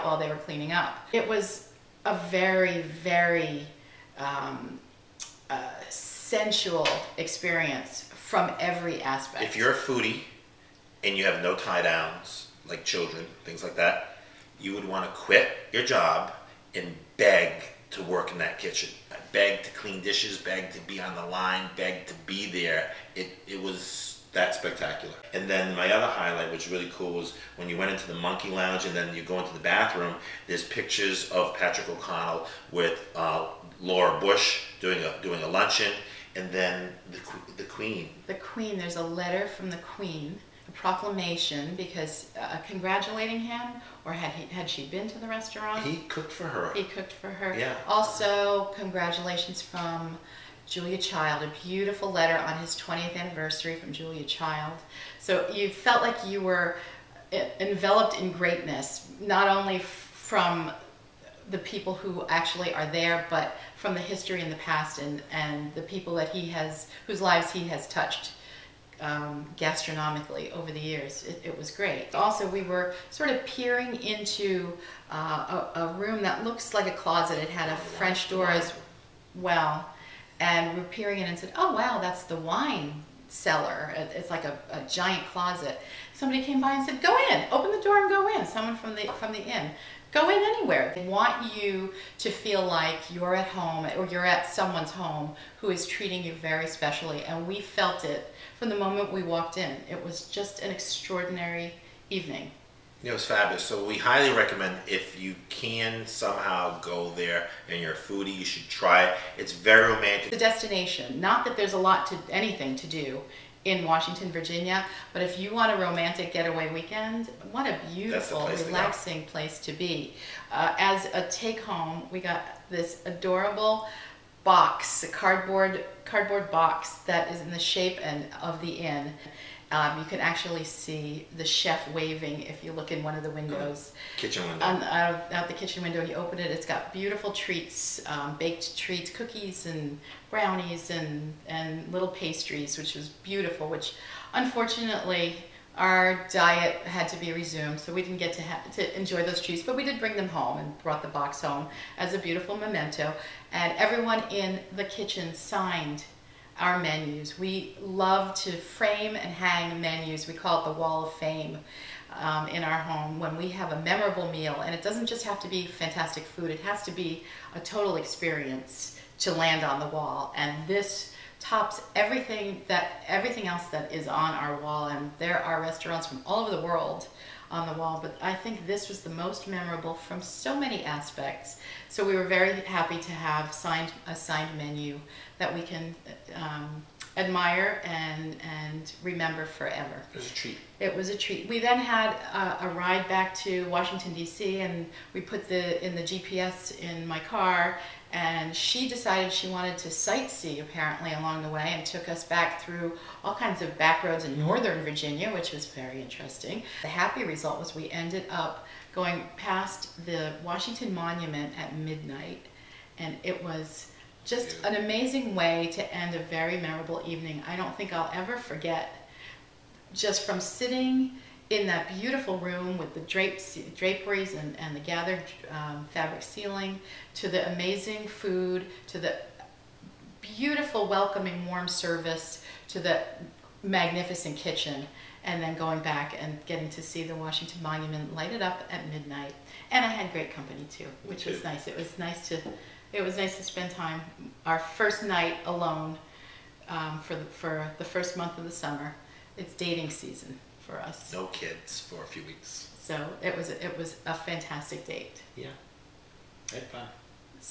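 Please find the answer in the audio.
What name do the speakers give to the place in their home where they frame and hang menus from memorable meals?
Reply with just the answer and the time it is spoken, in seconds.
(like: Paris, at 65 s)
the wall of fame, at 160 s.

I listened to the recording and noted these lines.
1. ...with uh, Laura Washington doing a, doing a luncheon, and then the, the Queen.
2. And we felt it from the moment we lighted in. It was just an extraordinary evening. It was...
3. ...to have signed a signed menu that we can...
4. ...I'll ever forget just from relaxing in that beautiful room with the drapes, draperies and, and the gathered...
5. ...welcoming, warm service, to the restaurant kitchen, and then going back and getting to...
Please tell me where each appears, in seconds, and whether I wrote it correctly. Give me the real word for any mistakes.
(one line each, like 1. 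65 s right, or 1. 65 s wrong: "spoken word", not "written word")
1. 32 s wrong: "Bush", not "Washington"
2. 97 s wrong: "walked", not "lighted"
3. 182 s right
4. 217 s wrong: "sitting", not "relaxing"
5. 230 s wrong: "magnificent", not "restaurant".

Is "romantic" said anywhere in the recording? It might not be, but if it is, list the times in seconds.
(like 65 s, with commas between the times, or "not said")
109 s, 115 s.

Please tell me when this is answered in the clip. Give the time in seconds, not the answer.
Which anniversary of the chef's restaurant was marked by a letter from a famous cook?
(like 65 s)
52 s.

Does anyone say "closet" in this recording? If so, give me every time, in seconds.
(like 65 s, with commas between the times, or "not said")
76 s, 85 s.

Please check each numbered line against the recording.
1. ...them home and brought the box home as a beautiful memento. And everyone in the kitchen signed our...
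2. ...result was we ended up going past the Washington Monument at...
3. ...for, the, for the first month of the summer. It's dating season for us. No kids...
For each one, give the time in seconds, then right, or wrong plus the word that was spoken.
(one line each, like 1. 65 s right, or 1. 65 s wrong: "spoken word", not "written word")
1. 150 s right
2. 207 s right
3. 247 s right.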